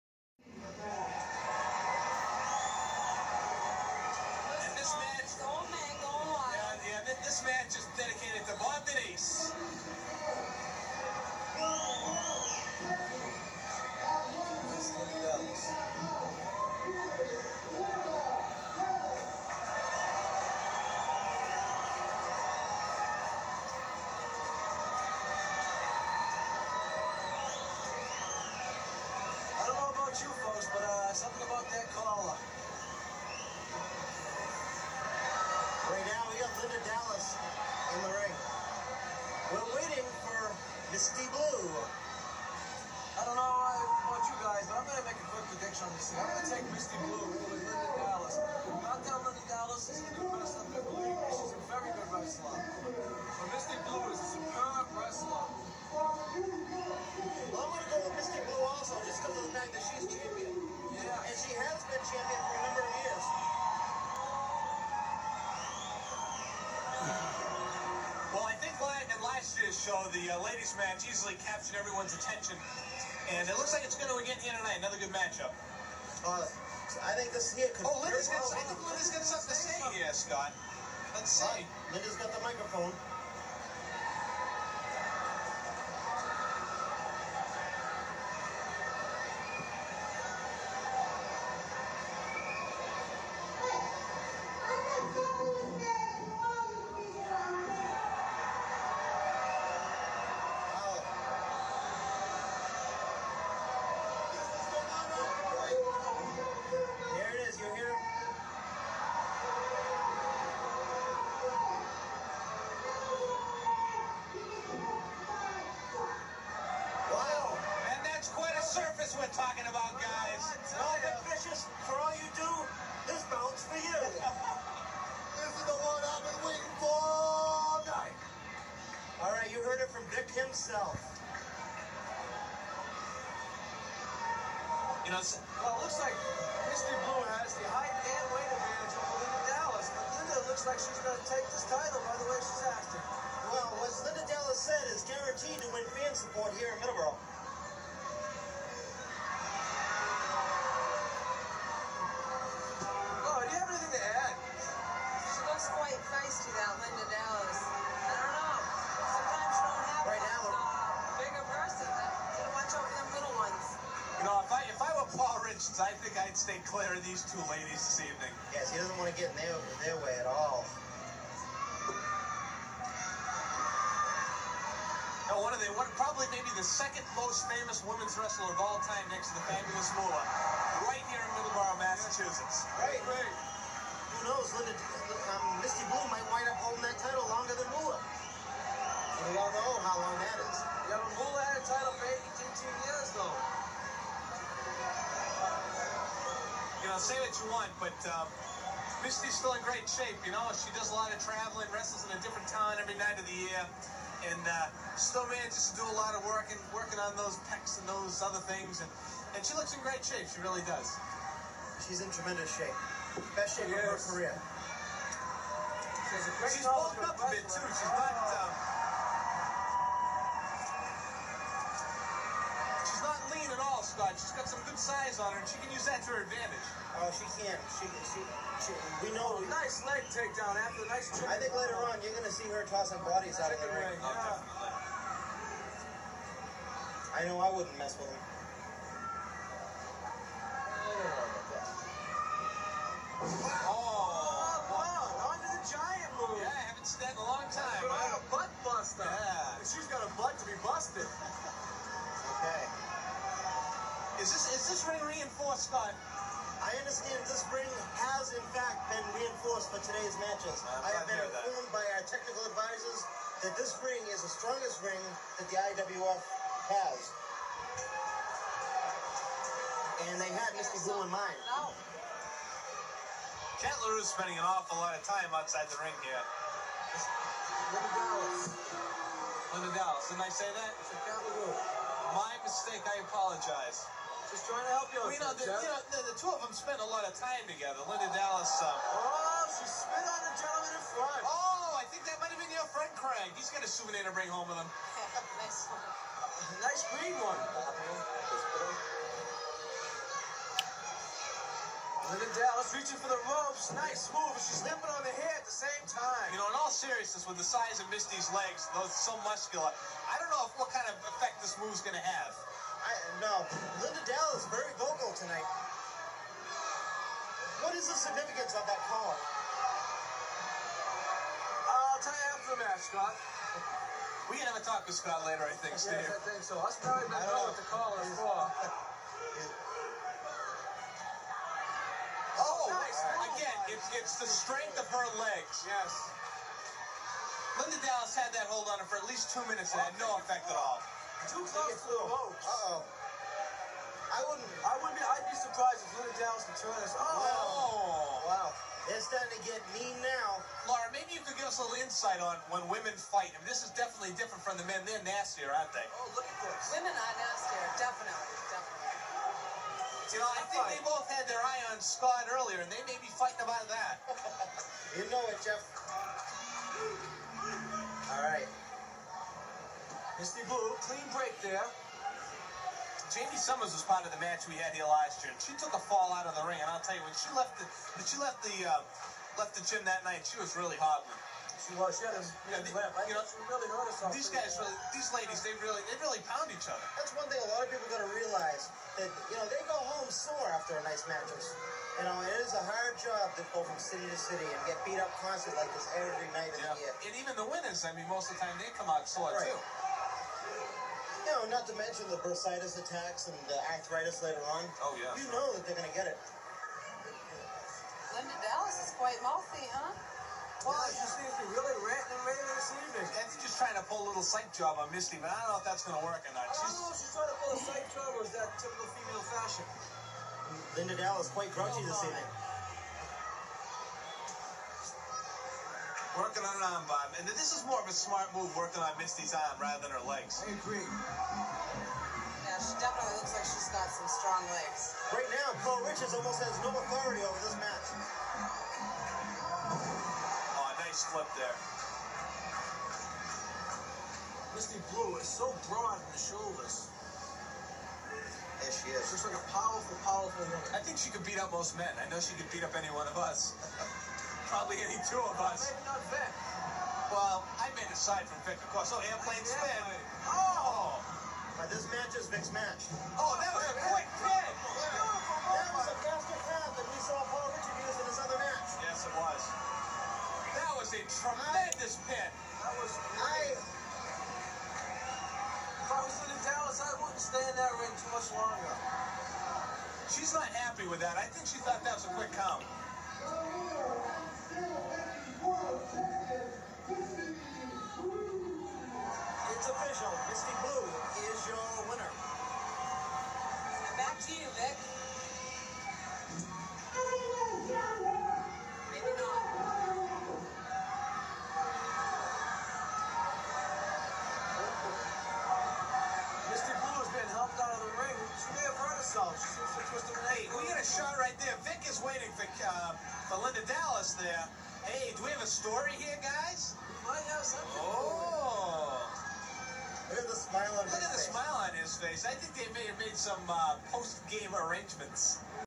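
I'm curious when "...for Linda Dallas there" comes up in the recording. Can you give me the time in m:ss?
8:33.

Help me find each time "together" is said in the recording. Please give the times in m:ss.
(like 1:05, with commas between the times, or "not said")
4:47.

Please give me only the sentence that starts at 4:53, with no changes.
He's got a souvenir to bring home with him.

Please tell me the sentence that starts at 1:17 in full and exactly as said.
Oh, Linda's got, Linda's got something to say here, Scott.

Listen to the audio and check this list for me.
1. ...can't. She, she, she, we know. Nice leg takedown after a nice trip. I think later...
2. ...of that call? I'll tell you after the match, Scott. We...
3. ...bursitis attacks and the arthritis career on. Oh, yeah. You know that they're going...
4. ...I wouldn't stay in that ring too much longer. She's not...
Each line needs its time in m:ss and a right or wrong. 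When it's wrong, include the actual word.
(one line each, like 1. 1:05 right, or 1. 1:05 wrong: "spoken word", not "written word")
1. 3:47 right
2. 5:18 right
3. 6:42 wrong: "later", not "career"
4. 7:56 right.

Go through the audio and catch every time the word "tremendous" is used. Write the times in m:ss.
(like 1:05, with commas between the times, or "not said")
3:32, 7:51.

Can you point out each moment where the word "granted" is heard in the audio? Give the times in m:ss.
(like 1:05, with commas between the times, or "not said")
not said.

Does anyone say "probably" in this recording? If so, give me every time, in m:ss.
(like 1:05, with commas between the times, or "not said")
2:55, 5:26, 7:34.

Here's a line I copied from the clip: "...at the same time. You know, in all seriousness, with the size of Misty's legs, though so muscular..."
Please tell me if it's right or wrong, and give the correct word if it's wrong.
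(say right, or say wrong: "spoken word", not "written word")
right.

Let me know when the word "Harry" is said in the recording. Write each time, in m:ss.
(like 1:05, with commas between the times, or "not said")
not said.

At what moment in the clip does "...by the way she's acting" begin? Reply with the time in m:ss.
2:22.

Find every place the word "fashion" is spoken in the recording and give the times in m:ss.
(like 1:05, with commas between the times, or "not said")
6:59.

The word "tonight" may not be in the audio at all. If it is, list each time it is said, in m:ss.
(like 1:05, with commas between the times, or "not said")
1:14, 5:15.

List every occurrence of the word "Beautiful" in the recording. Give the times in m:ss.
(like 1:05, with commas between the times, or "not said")
7:44.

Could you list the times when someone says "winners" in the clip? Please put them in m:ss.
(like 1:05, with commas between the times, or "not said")
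6:37, 8:11.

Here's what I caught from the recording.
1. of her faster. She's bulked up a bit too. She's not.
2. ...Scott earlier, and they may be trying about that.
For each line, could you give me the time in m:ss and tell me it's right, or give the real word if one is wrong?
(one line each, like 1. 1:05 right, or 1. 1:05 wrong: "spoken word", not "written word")
1. 3:33 wrong: "career", not "faster"
2. 6:01 wrong: "fighting", not "trying".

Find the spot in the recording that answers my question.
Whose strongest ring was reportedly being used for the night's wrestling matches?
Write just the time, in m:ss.
4:25.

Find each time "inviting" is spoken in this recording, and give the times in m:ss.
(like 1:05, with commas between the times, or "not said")
not said.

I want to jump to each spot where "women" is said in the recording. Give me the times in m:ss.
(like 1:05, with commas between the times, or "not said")
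2:57, 5:52, 5:56.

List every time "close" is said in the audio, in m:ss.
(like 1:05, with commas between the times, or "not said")
5:41.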